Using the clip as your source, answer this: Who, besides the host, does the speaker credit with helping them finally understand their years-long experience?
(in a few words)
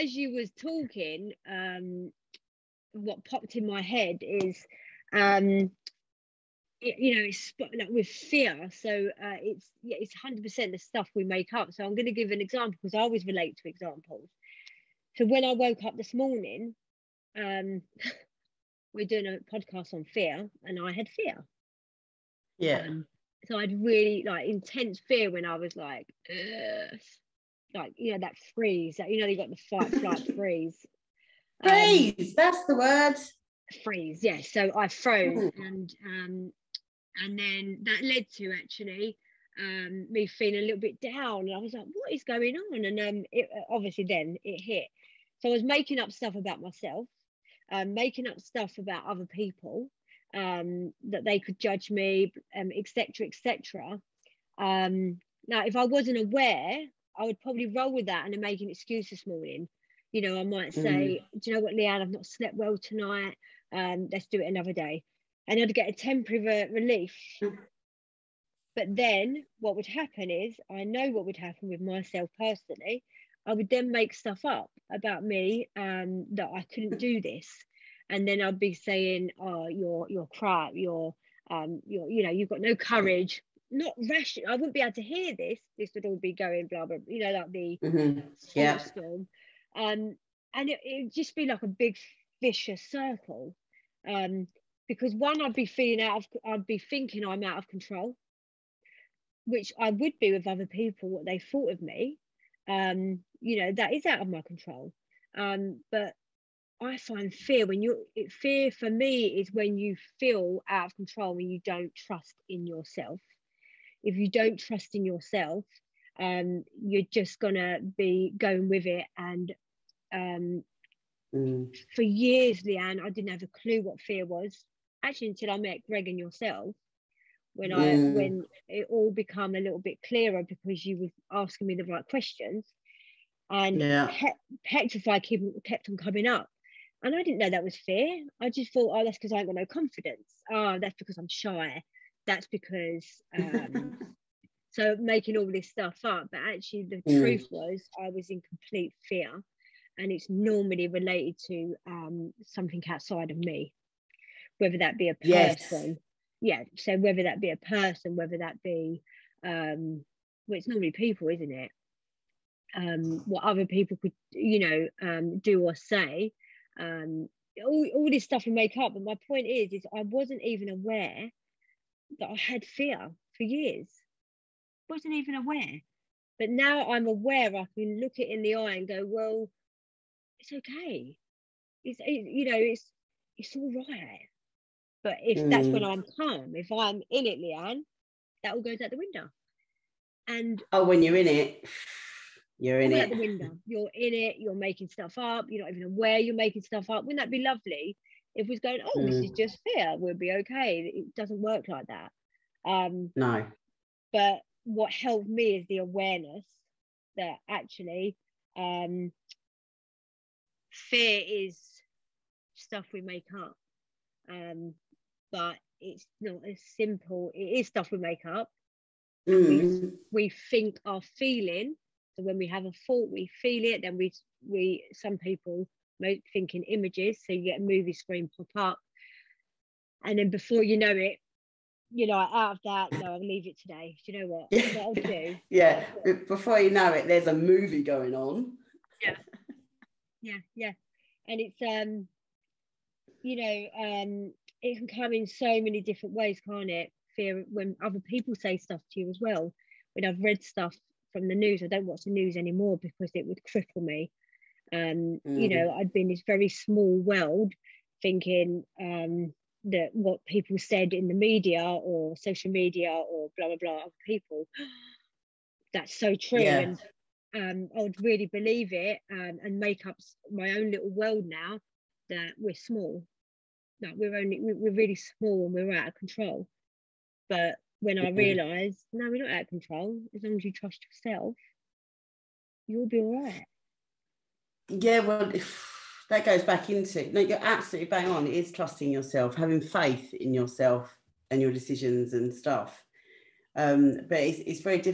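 Greg.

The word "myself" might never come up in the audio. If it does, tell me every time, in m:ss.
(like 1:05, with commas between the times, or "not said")
0:46, 1:11.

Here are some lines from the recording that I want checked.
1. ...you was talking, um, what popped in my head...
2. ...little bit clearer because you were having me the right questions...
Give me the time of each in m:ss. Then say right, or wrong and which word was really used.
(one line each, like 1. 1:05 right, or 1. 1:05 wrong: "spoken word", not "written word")
1. 0:00 right
2. 2:09 wrong: "asking", not "having".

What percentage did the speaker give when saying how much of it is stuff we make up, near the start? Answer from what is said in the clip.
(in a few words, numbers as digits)
100%.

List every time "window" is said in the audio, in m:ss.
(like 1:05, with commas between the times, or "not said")
3:08, 3:13.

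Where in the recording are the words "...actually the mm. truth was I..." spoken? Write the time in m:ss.
2:26.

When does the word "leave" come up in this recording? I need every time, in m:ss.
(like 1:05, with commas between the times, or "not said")
3:53.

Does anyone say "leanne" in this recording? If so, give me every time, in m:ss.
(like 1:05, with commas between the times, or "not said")
1:01, 2:02, 3:07.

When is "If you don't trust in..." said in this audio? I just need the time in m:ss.
1:54.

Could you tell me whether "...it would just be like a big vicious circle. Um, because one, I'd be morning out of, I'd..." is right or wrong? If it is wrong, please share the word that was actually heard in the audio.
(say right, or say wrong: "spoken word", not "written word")
wrong: "feeling", not "morning".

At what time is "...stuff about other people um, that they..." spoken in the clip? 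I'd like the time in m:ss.
0:48.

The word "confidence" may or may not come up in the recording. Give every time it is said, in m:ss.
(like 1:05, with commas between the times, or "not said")
2:19.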